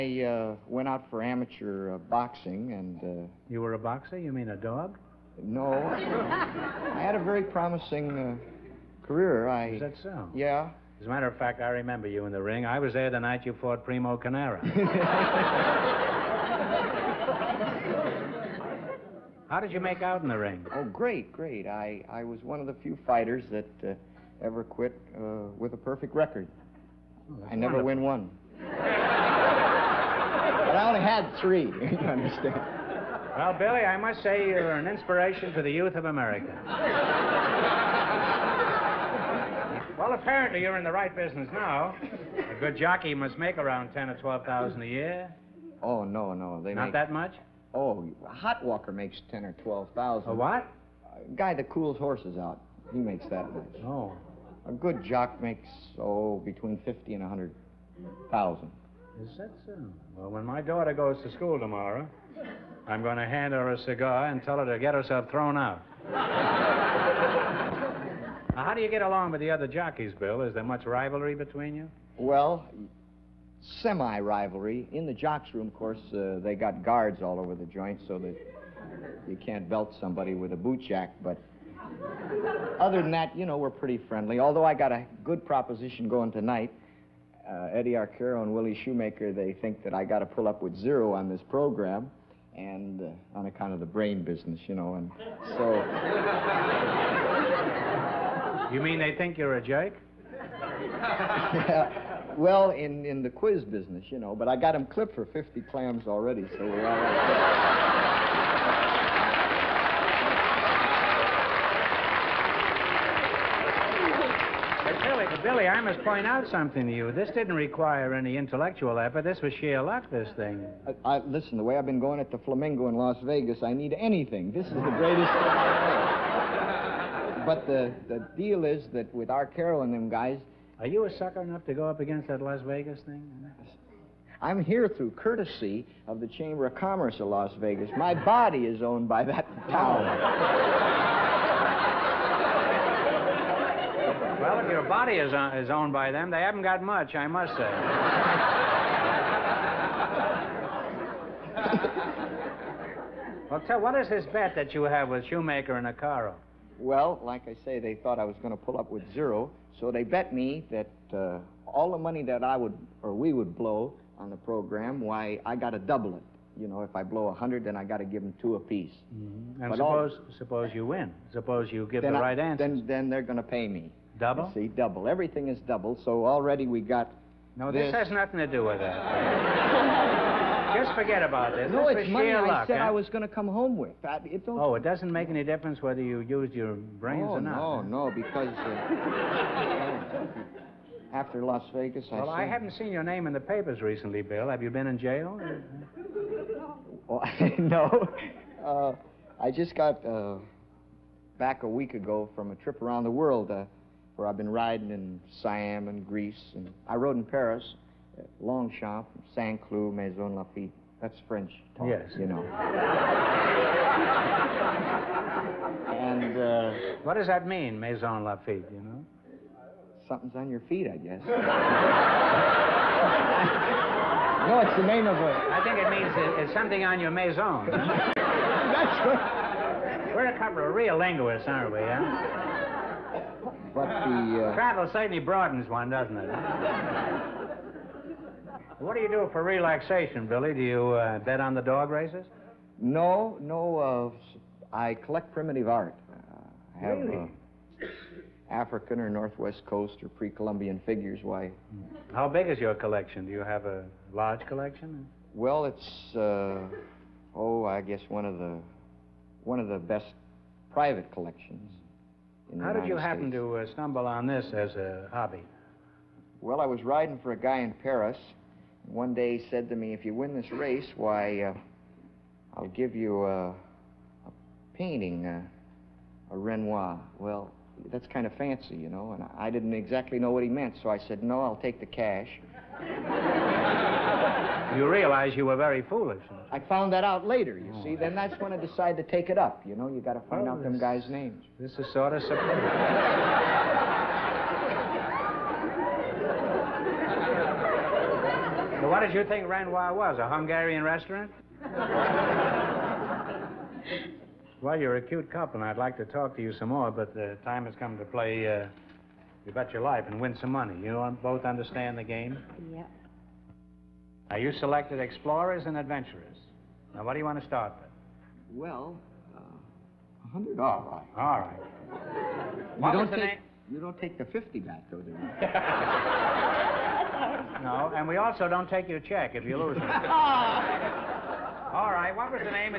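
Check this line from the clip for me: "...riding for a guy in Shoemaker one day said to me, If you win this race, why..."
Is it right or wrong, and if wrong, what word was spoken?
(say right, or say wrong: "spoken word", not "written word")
wrong: "Paris", not "Shoemaker".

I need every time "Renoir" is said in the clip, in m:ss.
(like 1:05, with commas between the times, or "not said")
4:36, 4:59.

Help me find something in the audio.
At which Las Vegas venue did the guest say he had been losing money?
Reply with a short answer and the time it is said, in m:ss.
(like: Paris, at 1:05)
the Flamingo, at 2:02.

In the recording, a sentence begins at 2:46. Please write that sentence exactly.
You know, if I blow a hundred, then I got to give them two apiece.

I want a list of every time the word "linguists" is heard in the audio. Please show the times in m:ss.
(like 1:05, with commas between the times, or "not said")
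3:50.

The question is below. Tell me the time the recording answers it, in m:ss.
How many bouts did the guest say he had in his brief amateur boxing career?
0:31.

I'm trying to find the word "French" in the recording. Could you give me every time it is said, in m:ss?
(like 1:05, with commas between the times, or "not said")
3:31.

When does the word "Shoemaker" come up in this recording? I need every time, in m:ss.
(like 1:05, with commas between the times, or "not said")
1:28, 2:35.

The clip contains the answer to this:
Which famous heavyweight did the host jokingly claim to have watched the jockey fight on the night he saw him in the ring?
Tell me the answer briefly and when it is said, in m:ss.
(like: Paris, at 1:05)
Primo Carnera, at 0:13.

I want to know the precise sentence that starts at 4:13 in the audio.
Do you have a large collection?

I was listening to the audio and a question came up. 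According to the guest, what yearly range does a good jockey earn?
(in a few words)
between 50 and 100,000.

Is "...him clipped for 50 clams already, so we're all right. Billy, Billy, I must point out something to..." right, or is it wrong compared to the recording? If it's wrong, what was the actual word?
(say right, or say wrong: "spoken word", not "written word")
right.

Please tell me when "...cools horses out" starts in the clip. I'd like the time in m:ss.
0:51.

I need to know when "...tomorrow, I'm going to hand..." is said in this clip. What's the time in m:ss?
1:01.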